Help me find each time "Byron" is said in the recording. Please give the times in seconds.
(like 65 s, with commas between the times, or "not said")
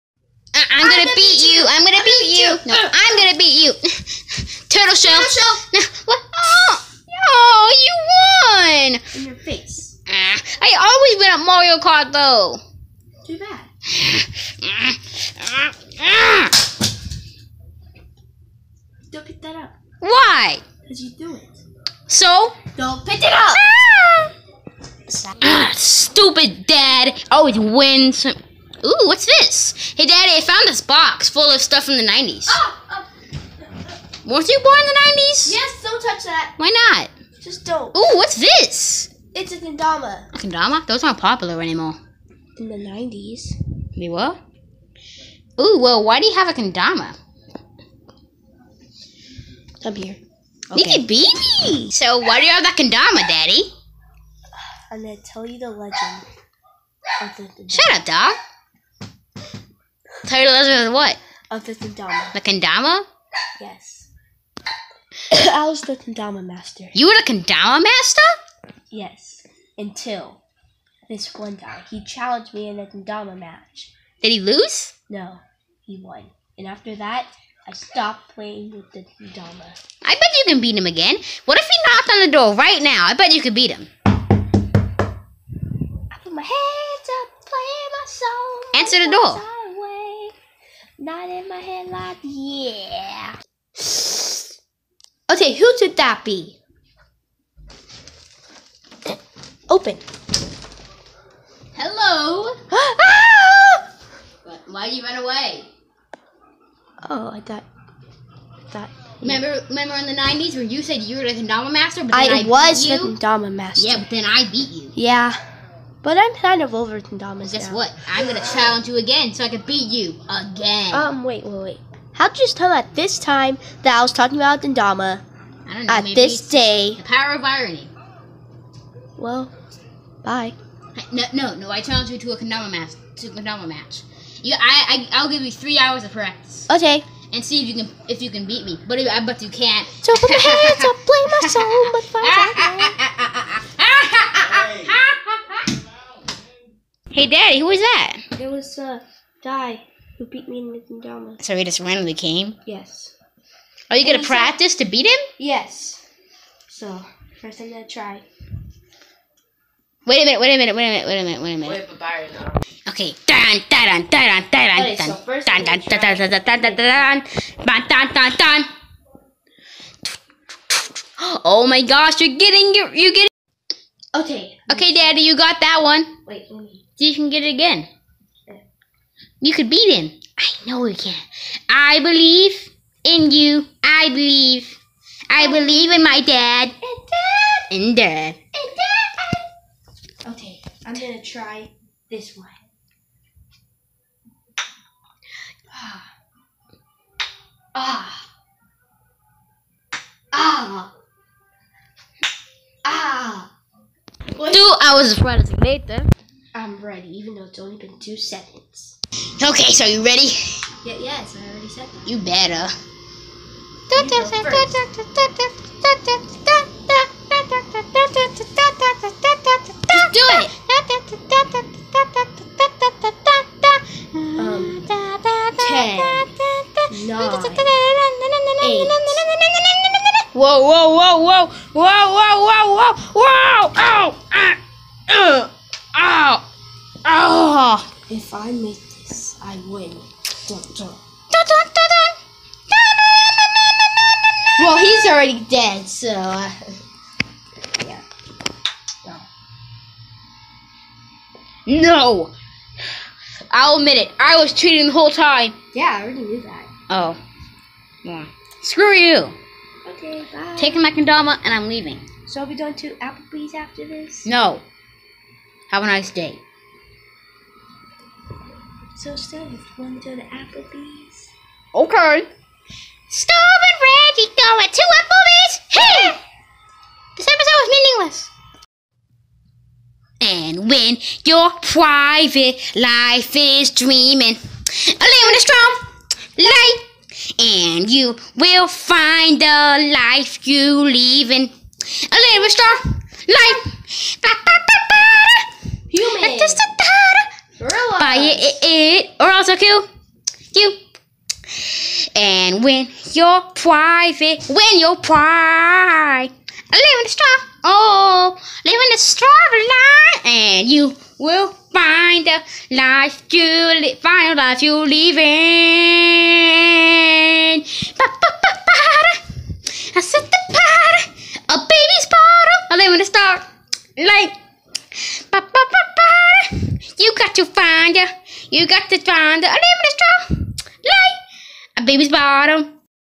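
161 s.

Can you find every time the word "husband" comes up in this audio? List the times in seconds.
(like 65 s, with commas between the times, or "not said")
60 s.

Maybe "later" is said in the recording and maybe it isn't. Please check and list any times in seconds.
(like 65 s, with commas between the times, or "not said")
205 s.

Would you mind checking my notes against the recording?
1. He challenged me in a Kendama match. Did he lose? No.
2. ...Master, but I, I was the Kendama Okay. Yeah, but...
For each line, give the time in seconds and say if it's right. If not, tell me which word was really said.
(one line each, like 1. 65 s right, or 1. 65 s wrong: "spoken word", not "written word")
1. 71 s right
2. 111 s wrong: "Master", not "Okay".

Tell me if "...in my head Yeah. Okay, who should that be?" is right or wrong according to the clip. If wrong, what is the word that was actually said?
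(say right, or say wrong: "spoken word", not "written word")
right.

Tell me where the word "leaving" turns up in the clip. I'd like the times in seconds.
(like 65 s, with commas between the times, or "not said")
261 s, 290 s.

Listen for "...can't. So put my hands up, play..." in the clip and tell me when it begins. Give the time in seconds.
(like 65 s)
139 s.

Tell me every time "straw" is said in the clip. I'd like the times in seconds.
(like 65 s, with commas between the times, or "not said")
308 s, 329 s.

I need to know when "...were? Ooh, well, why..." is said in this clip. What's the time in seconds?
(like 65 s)
44 s.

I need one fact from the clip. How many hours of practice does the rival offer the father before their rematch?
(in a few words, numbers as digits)
3.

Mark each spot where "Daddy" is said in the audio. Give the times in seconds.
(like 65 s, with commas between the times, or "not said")
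30 s, 53 s, 147 s, 174 s.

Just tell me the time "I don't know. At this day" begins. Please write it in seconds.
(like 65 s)
125 s.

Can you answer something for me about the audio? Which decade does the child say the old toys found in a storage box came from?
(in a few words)
the 90s.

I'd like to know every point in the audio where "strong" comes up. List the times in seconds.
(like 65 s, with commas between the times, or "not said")
285 s, 292 s.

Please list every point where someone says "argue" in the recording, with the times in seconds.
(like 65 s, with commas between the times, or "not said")
not said.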